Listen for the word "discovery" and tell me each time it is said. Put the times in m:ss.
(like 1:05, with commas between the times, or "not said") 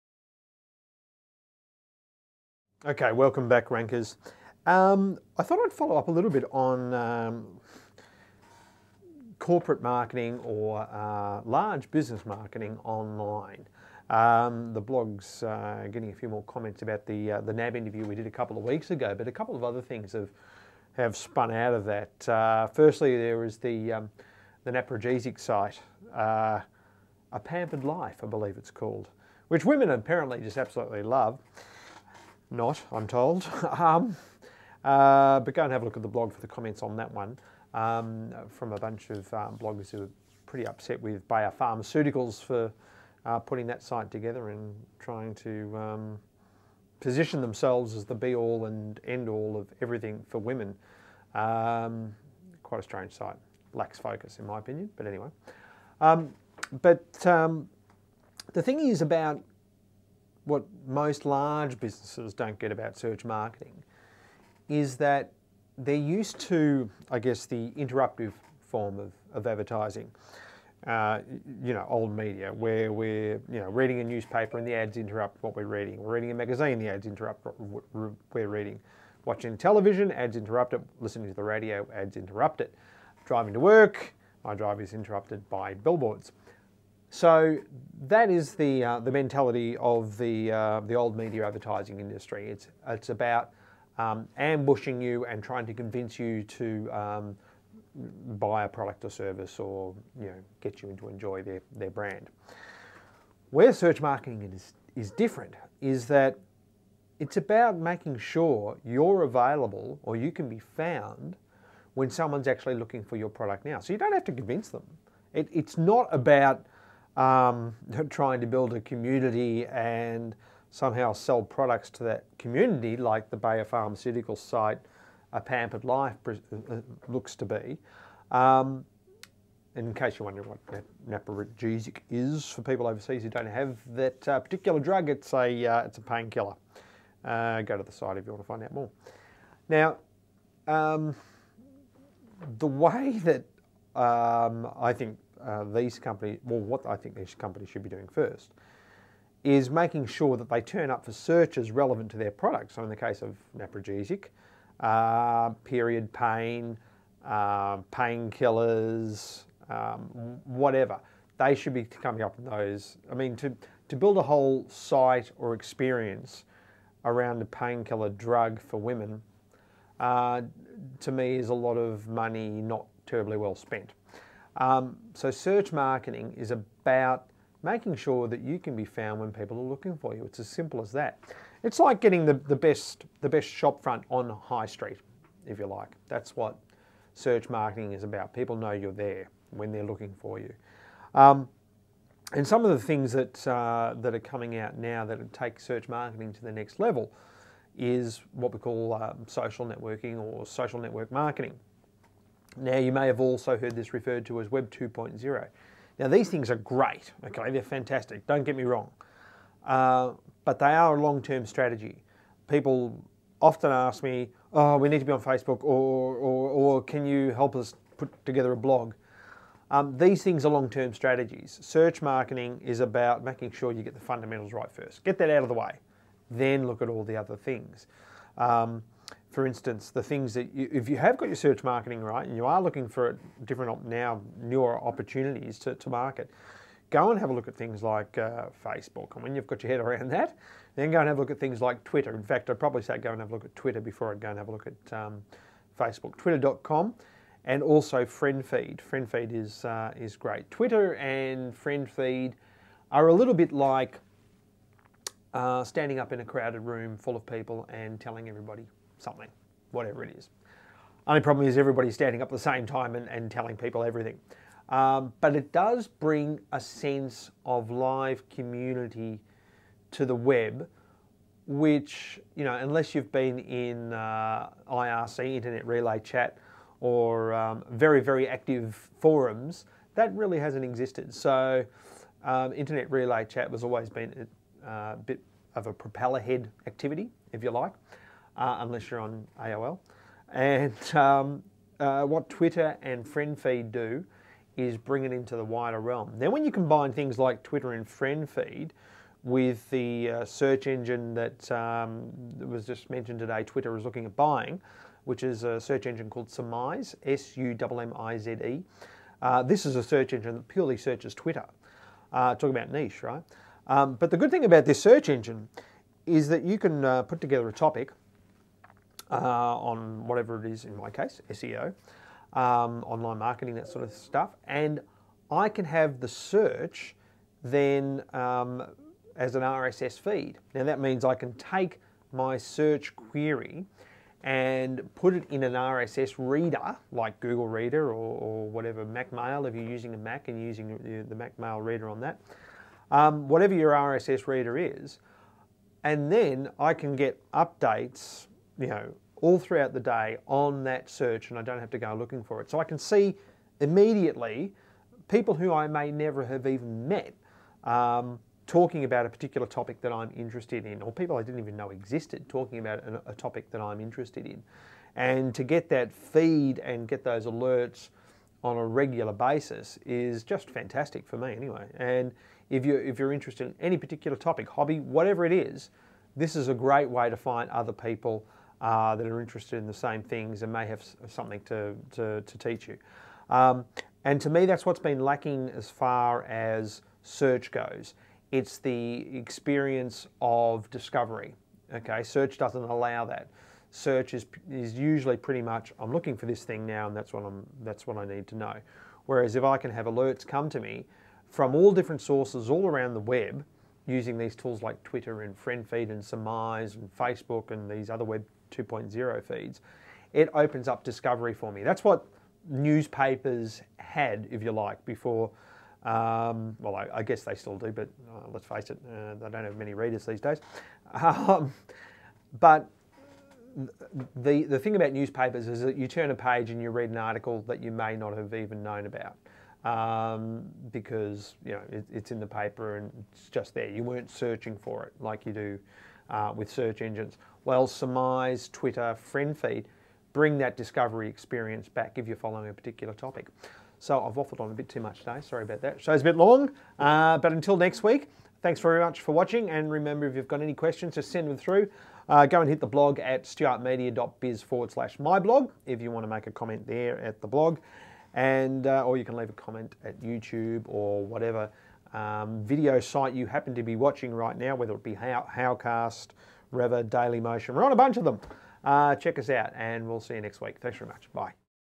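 6:30, 6:50, 7:20.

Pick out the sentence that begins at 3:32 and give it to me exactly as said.
People often ask me, oh, we need to be on Facebook, or, or, or can you help us put together a blog?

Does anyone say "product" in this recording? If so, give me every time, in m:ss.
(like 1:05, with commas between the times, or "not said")
1:38, 1:53, 2:01, 2:32.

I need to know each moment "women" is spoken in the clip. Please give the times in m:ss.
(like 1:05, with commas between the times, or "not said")
0:29, 0:50, 2:48.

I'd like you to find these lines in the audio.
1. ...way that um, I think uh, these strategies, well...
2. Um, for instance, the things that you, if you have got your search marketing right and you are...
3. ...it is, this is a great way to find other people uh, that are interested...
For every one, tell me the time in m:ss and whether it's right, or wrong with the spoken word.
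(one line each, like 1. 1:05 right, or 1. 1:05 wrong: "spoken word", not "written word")
1. 2:22 wrong: "companies", not "strategies"
2. 3:48 right
3. 6:15 right.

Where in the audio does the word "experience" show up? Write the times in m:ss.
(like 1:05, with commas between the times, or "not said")
2:45, 6:29, 7:21.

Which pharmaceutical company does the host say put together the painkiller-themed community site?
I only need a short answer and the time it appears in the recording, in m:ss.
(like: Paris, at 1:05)
Bayer Pharmaceuticals, at 0:41.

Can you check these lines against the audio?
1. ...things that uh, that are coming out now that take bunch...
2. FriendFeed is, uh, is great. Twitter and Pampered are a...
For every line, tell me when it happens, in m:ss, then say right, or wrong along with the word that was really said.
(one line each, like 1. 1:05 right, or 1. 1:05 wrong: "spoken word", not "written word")
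1. 3:12 wrong: "search", not "bunch"
2. 4:08 wrong: "FriendFeed", not "Pampered".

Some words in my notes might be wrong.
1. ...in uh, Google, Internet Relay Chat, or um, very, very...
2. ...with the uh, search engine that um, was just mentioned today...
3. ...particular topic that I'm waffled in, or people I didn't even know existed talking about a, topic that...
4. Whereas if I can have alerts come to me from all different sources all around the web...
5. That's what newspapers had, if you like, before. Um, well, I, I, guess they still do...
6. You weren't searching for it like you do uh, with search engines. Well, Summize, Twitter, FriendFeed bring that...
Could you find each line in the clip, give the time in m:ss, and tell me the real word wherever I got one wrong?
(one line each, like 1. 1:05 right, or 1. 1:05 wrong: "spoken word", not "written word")
1. 4:33 wrong: "IRC", not "Google"
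2. 4:59 right
3. 5:59 wrong: "interested", not "waffled"
4. 6:39 right
5. 6:51 right
6. 7:13 right.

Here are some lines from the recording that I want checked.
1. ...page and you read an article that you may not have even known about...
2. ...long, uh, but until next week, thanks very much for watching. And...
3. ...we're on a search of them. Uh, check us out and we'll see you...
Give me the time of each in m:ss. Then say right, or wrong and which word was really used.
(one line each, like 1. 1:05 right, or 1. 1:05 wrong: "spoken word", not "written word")
1. 7:06 right
2. 7:26 right
3. 7:47 wrong: "bunch", not "search".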